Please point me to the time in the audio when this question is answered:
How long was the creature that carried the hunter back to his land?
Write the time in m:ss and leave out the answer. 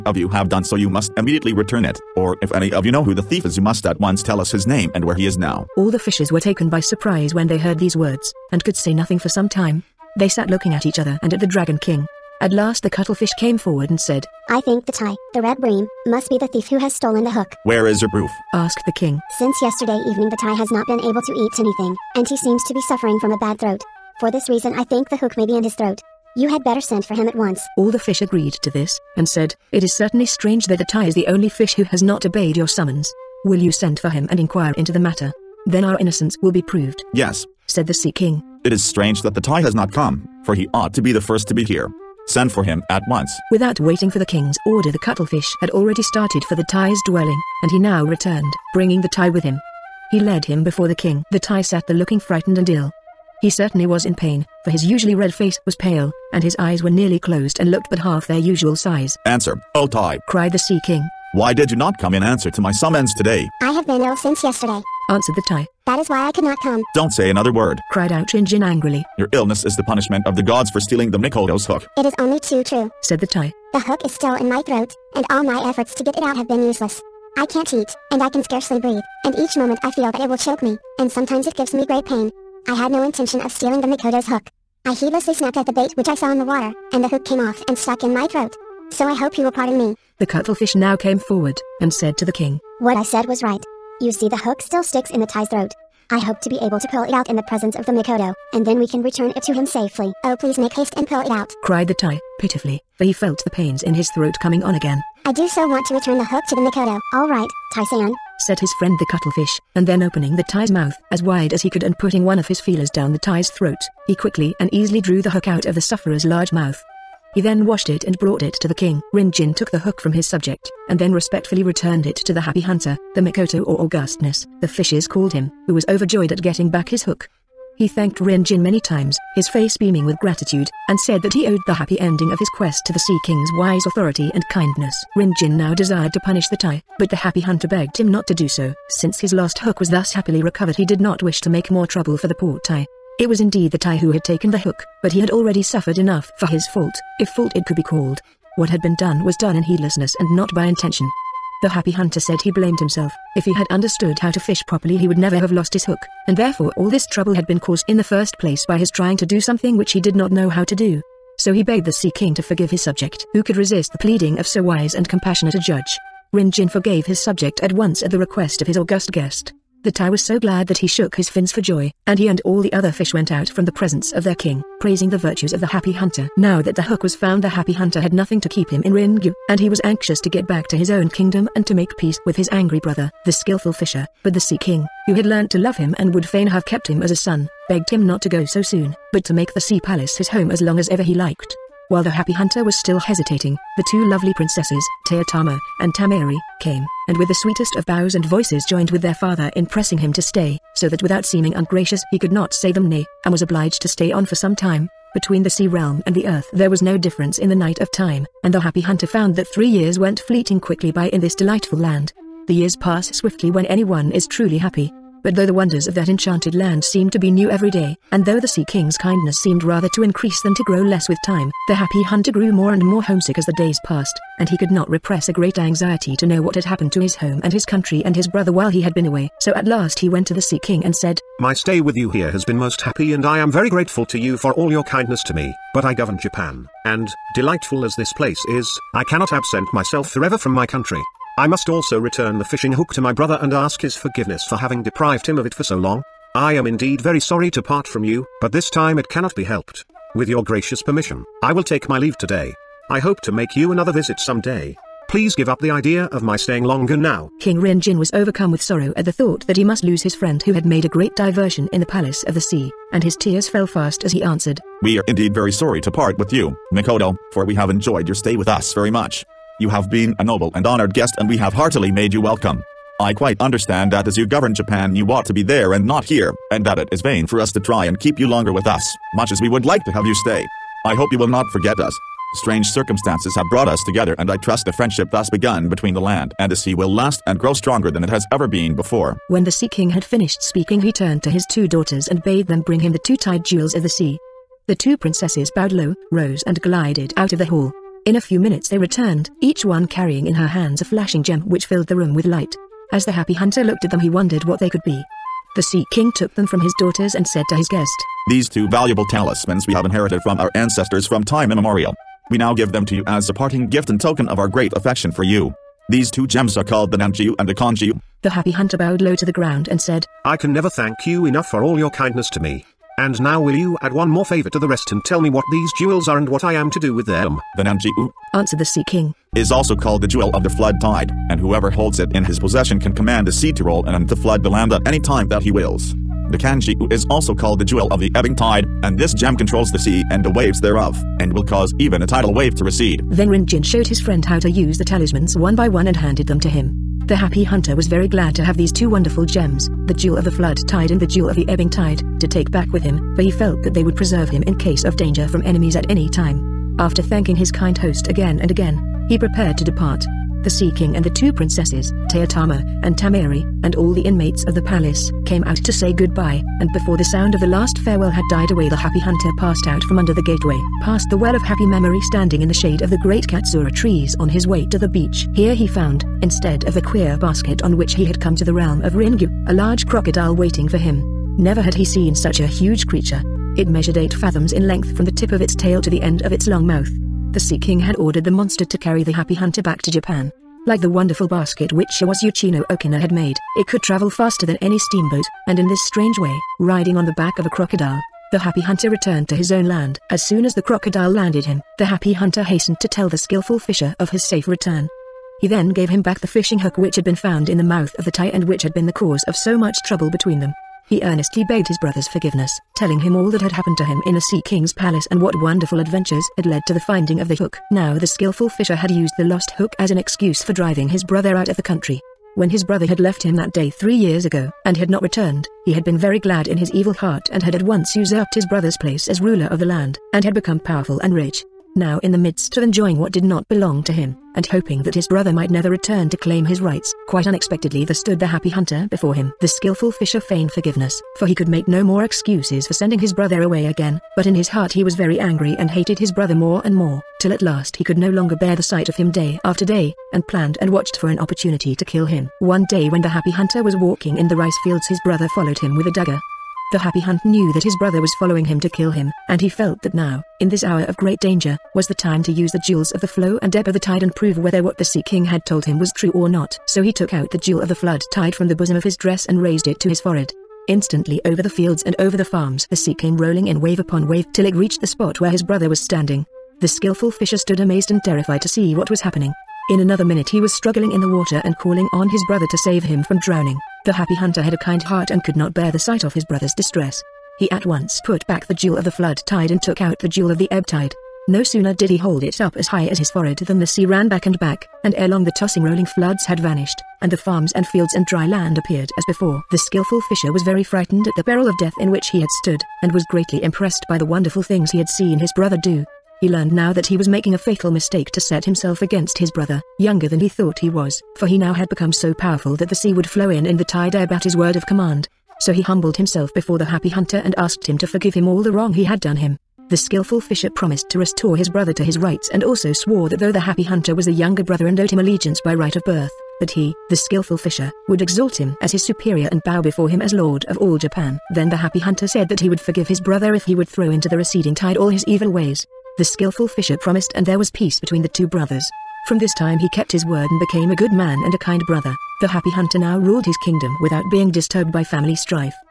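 6:23.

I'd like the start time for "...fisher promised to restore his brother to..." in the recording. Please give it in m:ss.
8:40.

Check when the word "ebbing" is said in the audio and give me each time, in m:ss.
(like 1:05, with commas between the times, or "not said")
5:38, 5:51.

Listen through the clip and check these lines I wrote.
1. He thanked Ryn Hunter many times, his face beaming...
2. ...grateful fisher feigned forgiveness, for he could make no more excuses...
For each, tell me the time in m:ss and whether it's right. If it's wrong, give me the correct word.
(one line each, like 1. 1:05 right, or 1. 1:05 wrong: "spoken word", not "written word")
1. 2:07 wrong: "Jin", not "Hunter"
2. 7:19 wrong: "skillful", not "grateful".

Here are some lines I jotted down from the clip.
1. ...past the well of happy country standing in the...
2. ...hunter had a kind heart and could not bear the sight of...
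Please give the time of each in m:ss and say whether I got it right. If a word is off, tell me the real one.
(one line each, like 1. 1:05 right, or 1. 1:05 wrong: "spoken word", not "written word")
1. 6:10 wrong: "memory", not "country"
2. 8:04 right.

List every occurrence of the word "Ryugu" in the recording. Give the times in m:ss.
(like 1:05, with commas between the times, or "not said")
2:58, 6:18.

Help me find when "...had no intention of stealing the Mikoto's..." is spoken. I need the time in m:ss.
1:22.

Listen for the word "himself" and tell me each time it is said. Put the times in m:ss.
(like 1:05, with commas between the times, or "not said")
2:32, 8:28, 8:35.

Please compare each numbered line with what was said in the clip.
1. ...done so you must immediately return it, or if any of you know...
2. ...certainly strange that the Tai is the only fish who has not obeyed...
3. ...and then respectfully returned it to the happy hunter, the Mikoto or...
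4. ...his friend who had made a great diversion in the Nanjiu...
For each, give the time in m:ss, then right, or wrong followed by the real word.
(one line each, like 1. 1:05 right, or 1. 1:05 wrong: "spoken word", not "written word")
1. 0:00 right
2. 0:29 right
3. 2:00 right
4. 4:20 wrong: "Palace", not "Nanjiu".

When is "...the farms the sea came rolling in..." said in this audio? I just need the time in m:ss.
7:52.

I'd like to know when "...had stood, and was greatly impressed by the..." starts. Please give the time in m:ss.
8:22.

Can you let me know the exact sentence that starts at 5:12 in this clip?
We now give them to you as a parting gift and token of our great affection for you.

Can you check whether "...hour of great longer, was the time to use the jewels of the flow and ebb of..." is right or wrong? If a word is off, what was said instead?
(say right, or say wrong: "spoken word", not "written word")
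wrong: "danger", not "longer".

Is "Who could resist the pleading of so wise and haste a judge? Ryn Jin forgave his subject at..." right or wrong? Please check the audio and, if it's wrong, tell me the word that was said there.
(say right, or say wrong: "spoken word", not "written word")
wrong: "compassionate", not "haste".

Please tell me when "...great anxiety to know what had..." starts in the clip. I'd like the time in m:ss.
3:45.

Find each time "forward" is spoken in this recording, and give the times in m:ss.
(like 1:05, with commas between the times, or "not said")
0:13, 1:31.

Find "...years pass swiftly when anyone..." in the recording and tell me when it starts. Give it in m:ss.
3:32.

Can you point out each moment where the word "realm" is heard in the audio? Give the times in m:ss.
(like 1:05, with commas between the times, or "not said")
3:25, 6:18.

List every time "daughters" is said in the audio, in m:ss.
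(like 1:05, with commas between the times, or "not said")
4:51, 5:06.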